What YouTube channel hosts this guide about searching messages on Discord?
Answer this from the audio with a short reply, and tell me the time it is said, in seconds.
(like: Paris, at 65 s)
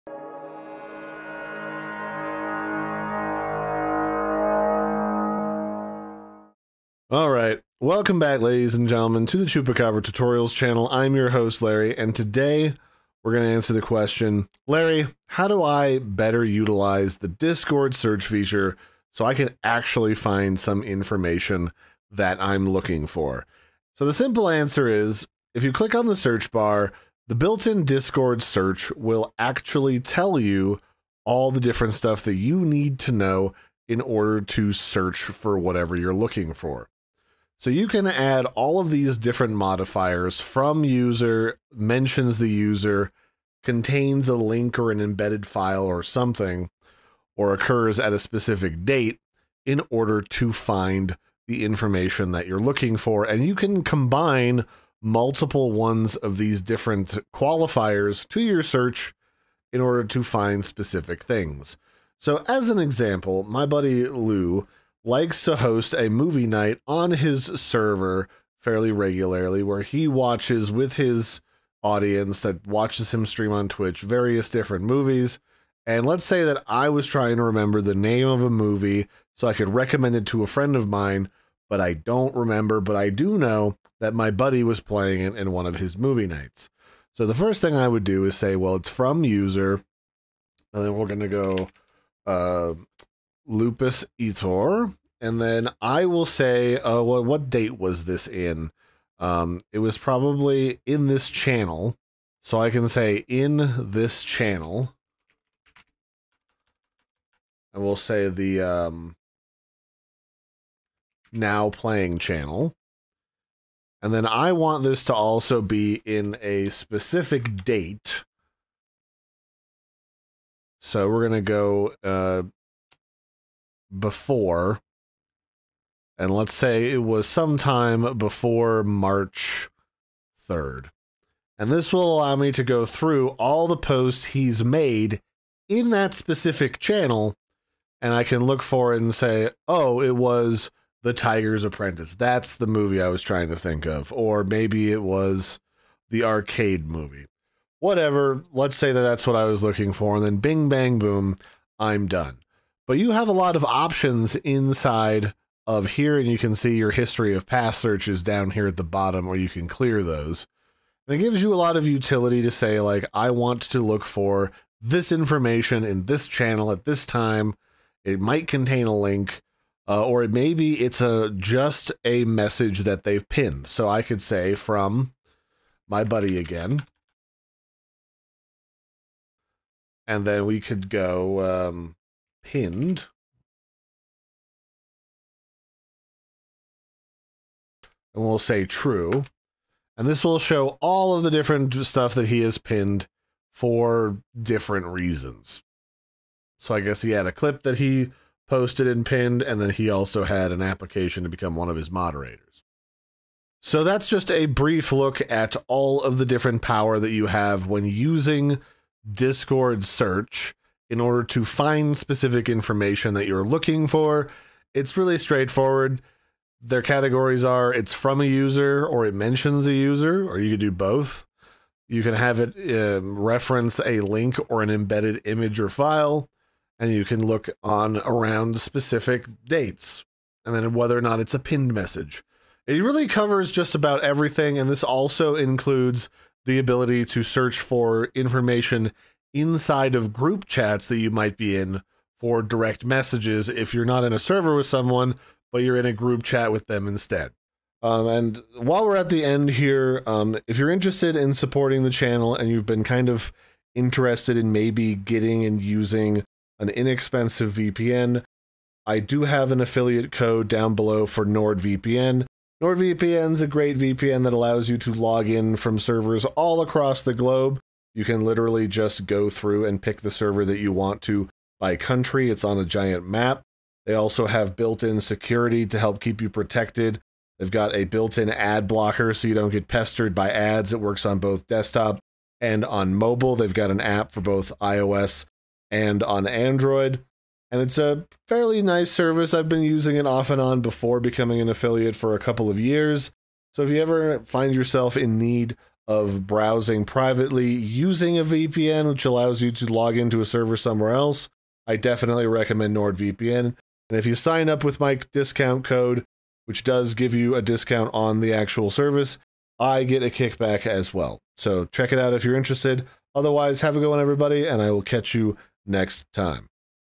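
Chupacabra Tutorials, at 9 s.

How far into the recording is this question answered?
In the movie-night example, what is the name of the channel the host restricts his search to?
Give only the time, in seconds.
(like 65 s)
111 s.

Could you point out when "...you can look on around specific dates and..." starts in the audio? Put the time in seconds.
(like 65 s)
226 s.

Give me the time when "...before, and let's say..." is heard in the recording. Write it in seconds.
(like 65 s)
123 s.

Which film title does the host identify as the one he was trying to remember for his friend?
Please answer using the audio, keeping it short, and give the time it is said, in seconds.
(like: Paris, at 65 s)
The Tiger's Apprentice, at 141 s.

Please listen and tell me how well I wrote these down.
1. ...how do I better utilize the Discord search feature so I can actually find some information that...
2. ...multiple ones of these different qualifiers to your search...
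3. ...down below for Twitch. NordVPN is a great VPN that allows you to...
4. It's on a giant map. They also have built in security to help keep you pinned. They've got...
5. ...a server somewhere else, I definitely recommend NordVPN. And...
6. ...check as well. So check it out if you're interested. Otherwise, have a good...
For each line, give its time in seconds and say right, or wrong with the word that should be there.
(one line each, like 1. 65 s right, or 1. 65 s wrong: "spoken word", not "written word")
1. 15 s right
2. 54 s right
3. 260 s wrong: "NordVPN", not "Twitch"
4. 272 s wrong: "protected", not "pinned"
5. 300 s right
6. 310 s wrong: "kickback", not "check".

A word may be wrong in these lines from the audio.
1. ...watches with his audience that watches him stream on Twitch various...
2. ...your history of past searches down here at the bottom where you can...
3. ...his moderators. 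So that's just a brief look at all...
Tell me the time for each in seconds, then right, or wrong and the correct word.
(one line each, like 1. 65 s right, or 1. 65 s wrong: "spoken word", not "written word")
1. 70 s right
2. 156 s right
3. 201 s right.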